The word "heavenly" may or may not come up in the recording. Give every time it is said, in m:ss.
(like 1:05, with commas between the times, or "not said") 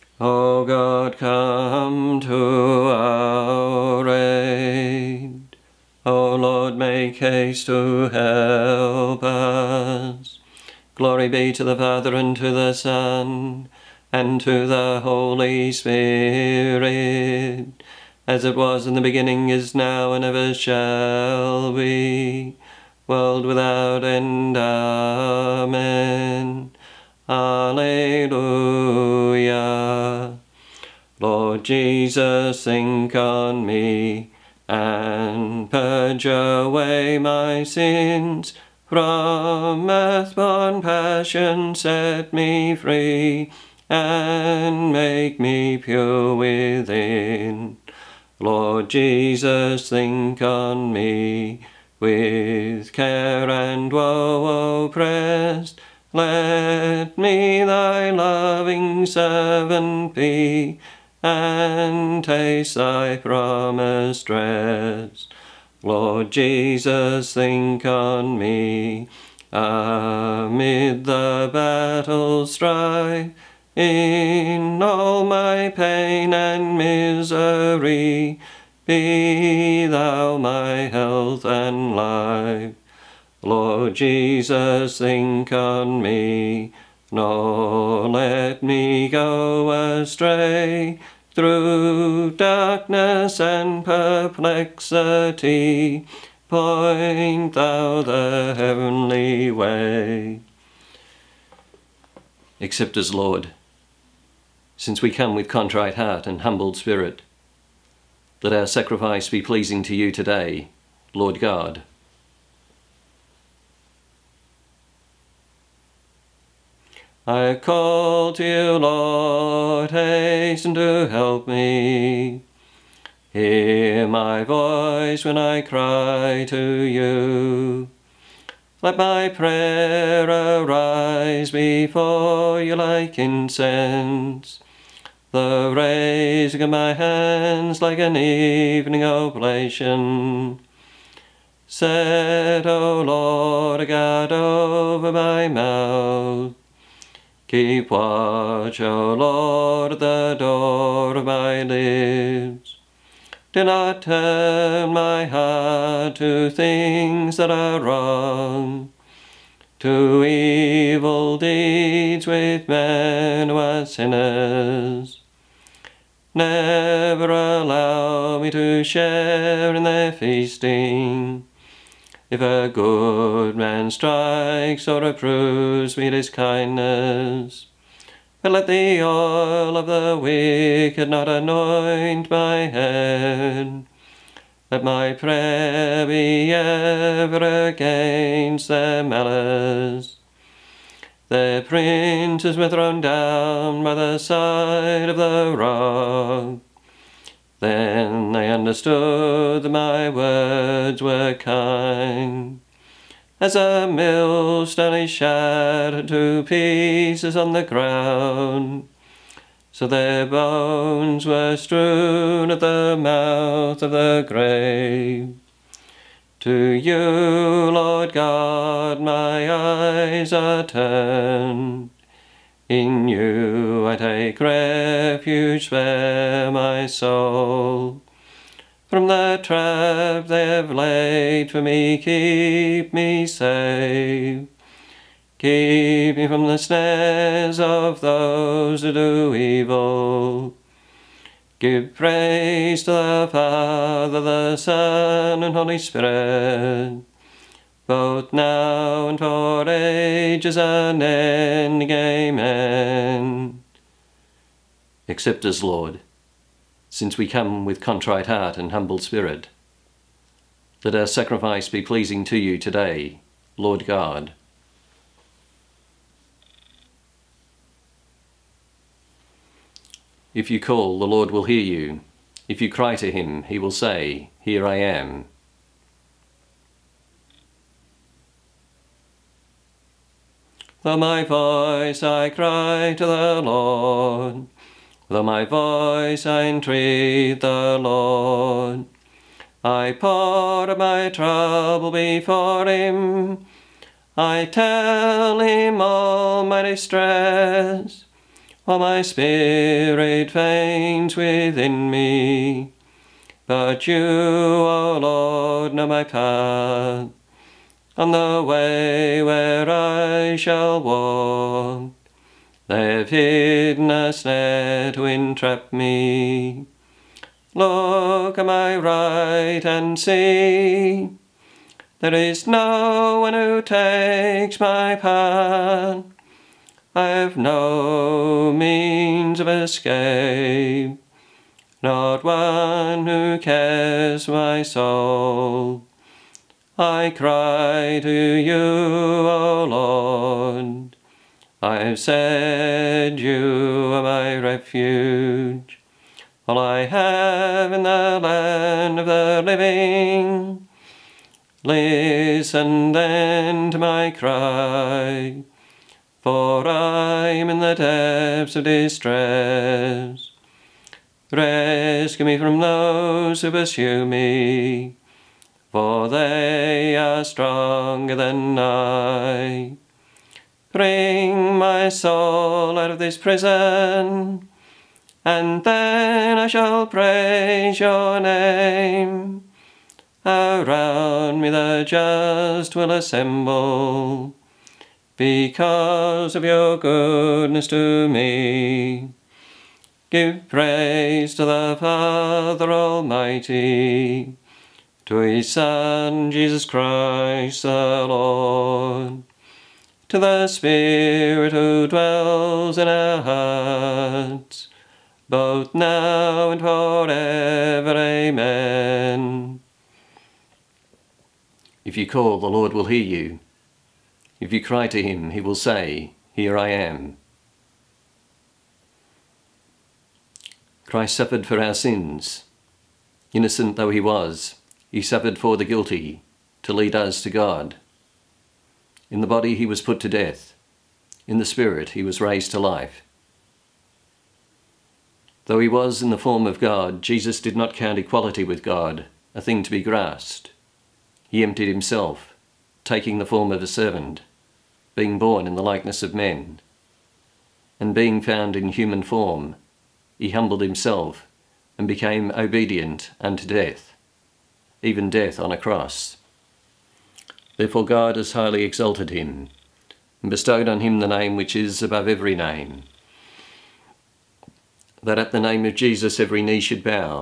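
1:38.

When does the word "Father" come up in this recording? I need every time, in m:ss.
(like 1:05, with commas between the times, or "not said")
0:11, 4:03, 6:31.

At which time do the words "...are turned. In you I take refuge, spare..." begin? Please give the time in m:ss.
3:40.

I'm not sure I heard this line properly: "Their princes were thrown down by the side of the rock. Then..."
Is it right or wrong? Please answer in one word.
right.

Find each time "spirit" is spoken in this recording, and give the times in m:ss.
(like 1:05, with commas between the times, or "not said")
0:15, 1:46, 4:05, 4:18, 4:59, 6:40, 7:11.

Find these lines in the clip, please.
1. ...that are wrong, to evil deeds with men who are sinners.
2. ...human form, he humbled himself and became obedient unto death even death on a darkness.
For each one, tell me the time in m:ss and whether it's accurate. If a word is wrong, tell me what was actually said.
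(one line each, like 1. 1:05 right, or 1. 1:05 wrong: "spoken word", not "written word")
1. 2:37 right
2. 7:28 wrong: "cross", not "darkness".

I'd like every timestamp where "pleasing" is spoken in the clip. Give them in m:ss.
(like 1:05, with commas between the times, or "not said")
1:49, 4:21.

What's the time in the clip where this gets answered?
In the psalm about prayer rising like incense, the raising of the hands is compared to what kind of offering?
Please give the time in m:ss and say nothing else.
2:17.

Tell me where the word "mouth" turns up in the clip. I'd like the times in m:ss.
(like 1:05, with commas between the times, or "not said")
2:25, 3:32.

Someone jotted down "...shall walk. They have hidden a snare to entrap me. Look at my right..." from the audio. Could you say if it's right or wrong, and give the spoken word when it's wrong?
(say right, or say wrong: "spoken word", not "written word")
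right.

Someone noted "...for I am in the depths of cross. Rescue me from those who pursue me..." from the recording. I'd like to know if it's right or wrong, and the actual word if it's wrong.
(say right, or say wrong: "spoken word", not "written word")
wrong: "distress", not "cross".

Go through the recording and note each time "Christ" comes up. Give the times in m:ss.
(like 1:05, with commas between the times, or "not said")
6:36, 7:00.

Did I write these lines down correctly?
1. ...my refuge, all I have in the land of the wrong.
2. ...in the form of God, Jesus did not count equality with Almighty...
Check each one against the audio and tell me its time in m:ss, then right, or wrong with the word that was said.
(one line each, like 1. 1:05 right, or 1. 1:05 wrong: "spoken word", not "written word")
1. 5:44 wrong: "living", not "wrong"
2. 7:16 wrong: "God", not "Almighty".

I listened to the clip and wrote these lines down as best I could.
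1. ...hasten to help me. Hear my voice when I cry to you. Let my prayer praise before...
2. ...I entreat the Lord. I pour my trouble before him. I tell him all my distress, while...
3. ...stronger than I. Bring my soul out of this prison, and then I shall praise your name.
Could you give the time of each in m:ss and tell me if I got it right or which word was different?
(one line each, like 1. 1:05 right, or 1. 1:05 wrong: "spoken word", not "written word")
1. 1:59 wrong: "arise", not "praise"
2. 4:46 right
3. 6:07 right.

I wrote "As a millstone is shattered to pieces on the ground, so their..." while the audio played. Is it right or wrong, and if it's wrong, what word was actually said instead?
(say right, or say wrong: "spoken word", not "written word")
right.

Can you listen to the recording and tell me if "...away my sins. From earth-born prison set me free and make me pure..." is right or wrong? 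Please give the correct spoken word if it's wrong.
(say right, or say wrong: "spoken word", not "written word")
wrong: "passion", not "prison".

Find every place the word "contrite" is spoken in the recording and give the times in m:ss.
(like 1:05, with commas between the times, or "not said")
1:45, 4:17.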